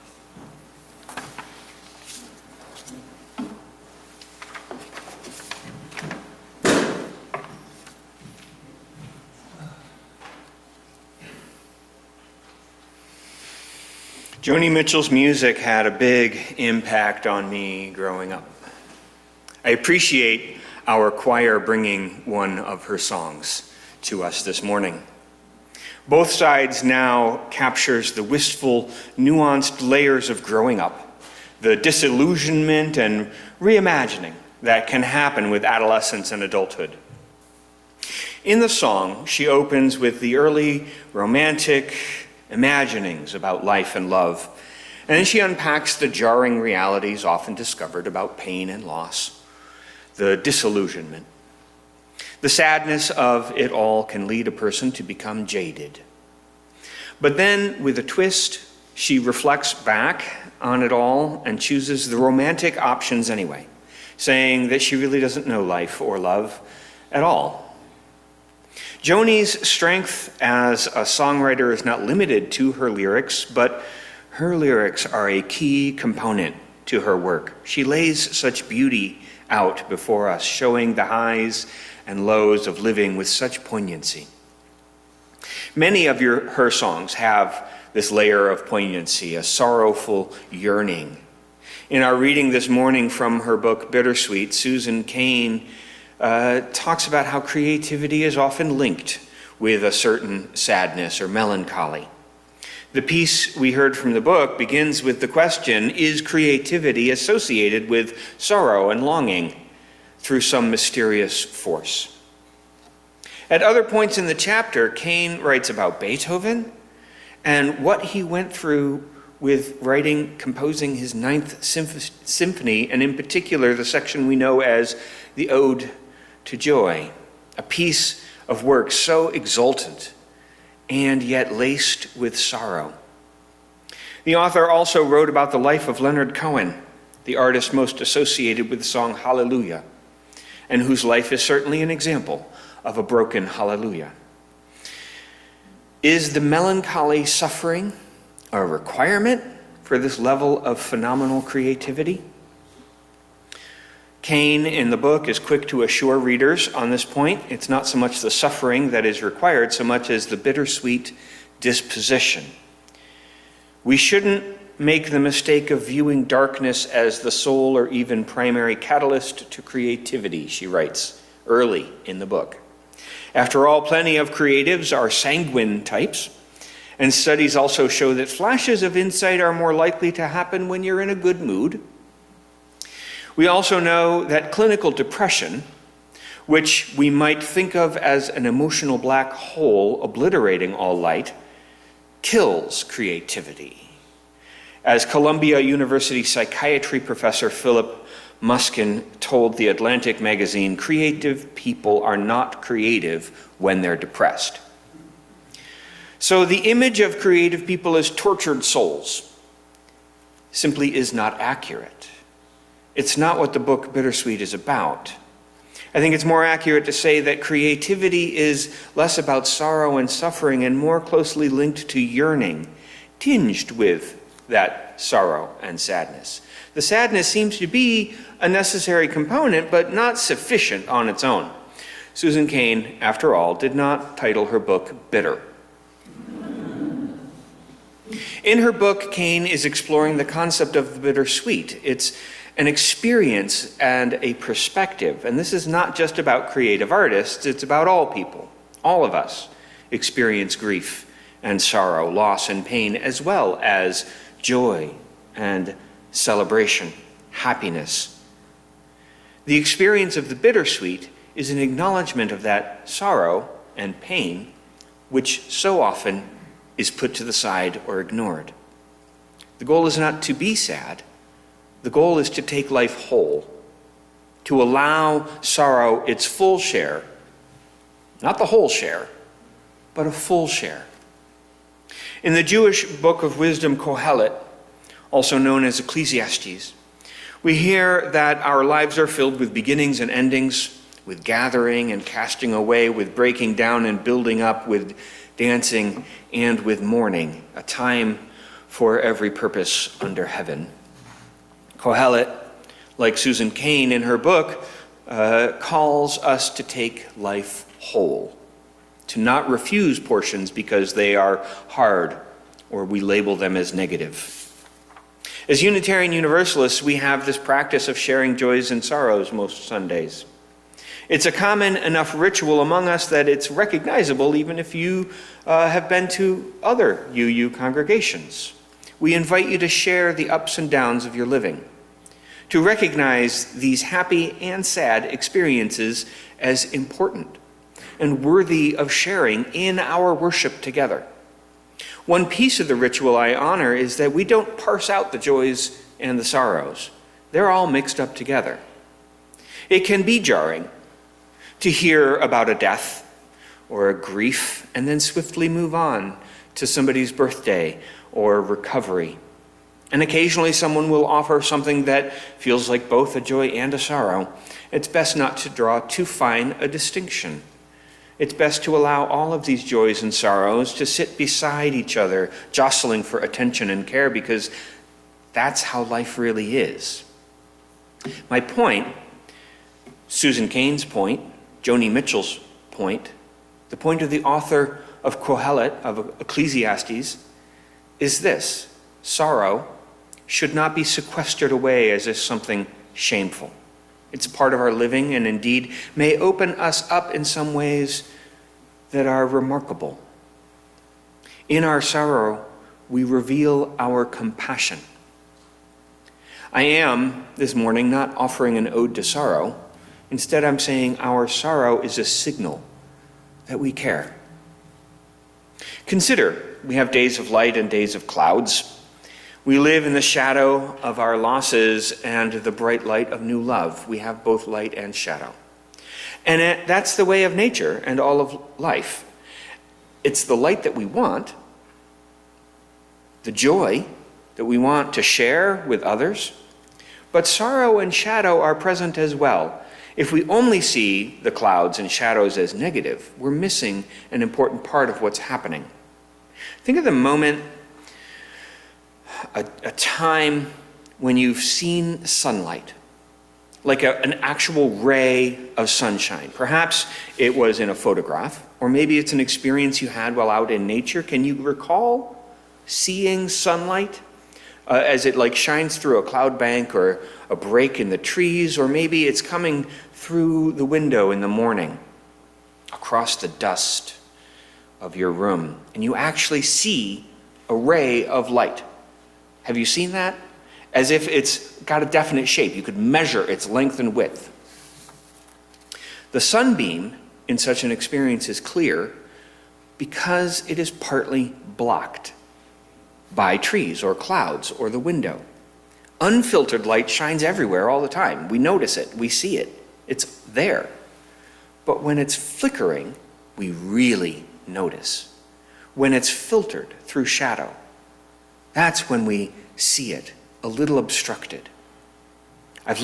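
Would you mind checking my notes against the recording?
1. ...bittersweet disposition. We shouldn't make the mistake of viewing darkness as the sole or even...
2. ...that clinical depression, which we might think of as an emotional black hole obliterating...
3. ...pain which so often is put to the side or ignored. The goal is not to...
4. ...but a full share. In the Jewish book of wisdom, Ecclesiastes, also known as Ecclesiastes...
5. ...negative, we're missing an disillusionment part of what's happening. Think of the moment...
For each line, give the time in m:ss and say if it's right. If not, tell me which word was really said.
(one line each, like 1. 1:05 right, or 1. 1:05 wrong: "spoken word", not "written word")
1. 2:40 right
2. 3:04 right
3. 4:24 right
4. 4:39 wrong: "Kohelet", not "Ecclesiastes"
5. 7:22 wrong: "important", not "disillusionment".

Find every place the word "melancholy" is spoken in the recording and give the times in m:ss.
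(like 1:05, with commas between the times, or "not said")
1:41, 2:26.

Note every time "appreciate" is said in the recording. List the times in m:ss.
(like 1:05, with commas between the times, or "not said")
0:19.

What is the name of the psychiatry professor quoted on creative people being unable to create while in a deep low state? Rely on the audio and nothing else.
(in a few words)
Philip Muskin.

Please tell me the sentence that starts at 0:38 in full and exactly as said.
In the song, she opens with the early romantic, imaginings about life and love.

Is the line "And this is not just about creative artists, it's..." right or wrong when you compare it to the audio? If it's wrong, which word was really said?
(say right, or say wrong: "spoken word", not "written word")
right.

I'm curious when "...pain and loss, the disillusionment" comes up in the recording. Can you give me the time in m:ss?
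0:48.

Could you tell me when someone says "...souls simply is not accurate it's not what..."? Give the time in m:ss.
3:28.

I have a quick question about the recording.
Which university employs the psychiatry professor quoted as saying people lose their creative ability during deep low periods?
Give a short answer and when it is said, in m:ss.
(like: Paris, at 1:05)
Columbia University, at 3:15.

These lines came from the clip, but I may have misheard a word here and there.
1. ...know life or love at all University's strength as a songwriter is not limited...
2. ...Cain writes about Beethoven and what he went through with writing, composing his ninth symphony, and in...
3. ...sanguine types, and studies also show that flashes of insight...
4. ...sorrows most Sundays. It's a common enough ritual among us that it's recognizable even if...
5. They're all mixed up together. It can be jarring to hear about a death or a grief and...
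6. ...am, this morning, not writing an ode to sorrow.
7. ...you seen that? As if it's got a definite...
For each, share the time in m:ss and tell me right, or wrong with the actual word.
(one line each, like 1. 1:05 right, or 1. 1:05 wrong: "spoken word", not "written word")
1. 1:05 wrong: "Joni", not "University"
2. 1:54 right
3. 2:55 right
4. 5:18 right
5. 5:47 right
6. 6:46 wrong: "offering", not "writing"
7. 7:59 right.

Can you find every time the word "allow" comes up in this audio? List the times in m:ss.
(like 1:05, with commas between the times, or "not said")
4:34, 6:08.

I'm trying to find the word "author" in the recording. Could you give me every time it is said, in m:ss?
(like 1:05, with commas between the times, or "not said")
2:14, 6:24.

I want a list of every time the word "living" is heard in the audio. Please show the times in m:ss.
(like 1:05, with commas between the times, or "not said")
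1:22, 5:31, 6:34.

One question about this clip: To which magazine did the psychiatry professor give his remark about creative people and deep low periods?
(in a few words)
The Atlantic.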